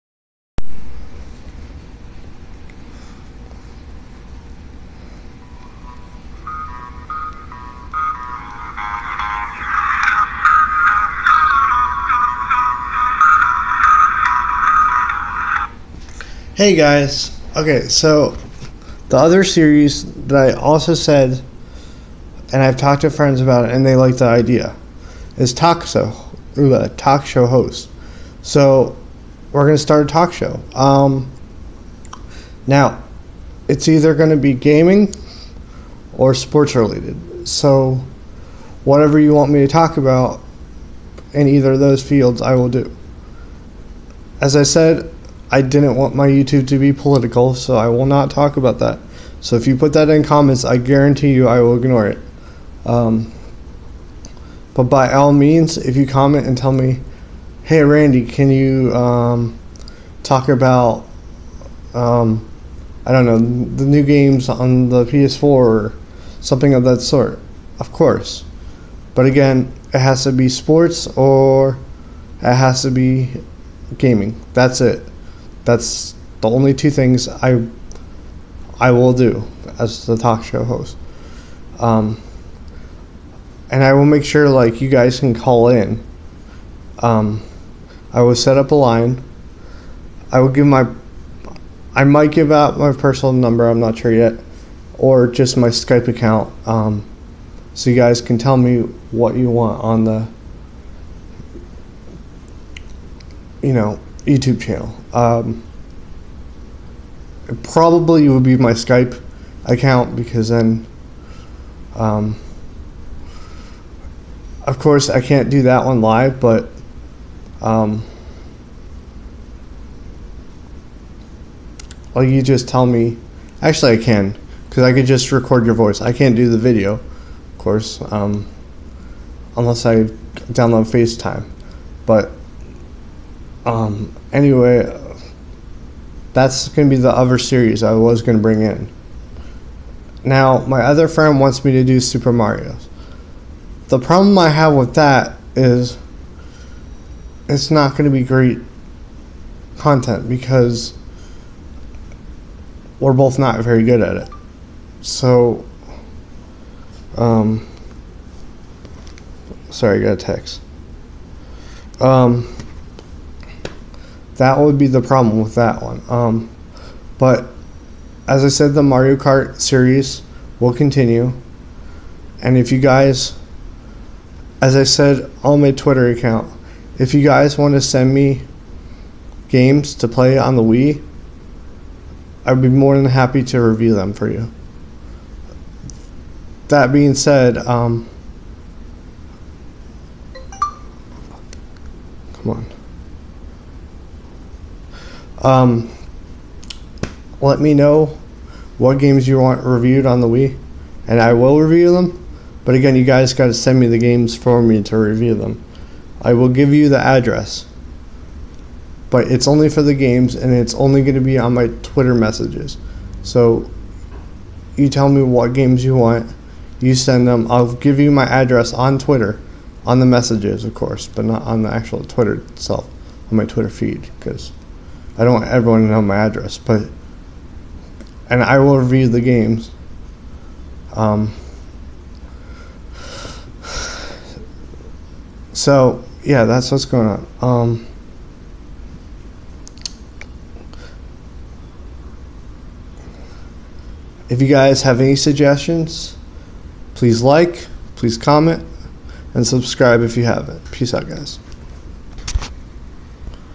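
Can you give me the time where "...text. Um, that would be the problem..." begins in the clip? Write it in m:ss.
2:40.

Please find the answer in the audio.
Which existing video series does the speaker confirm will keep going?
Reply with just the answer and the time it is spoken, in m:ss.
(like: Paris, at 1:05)
Mario Kart, at 2:48.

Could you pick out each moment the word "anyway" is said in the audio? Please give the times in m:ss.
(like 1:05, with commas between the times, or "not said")
2:14.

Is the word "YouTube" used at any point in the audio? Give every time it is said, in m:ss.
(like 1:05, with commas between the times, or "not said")
0:46, 1:44.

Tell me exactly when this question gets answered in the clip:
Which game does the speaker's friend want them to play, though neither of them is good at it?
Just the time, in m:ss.
2:21.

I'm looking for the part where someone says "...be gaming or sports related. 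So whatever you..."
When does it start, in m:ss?
0:34.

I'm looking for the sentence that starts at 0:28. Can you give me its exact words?
So we're gonna start a talk show.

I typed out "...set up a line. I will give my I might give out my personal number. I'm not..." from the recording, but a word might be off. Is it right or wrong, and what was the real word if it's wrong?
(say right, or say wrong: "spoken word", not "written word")
right.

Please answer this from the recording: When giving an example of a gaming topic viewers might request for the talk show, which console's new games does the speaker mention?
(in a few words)
PS4.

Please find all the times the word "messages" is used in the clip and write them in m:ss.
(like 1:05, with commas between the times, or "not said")
3:32, 3:40.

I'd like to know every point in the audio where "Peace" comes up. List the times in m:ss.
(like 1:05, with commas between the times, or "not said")
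4:10.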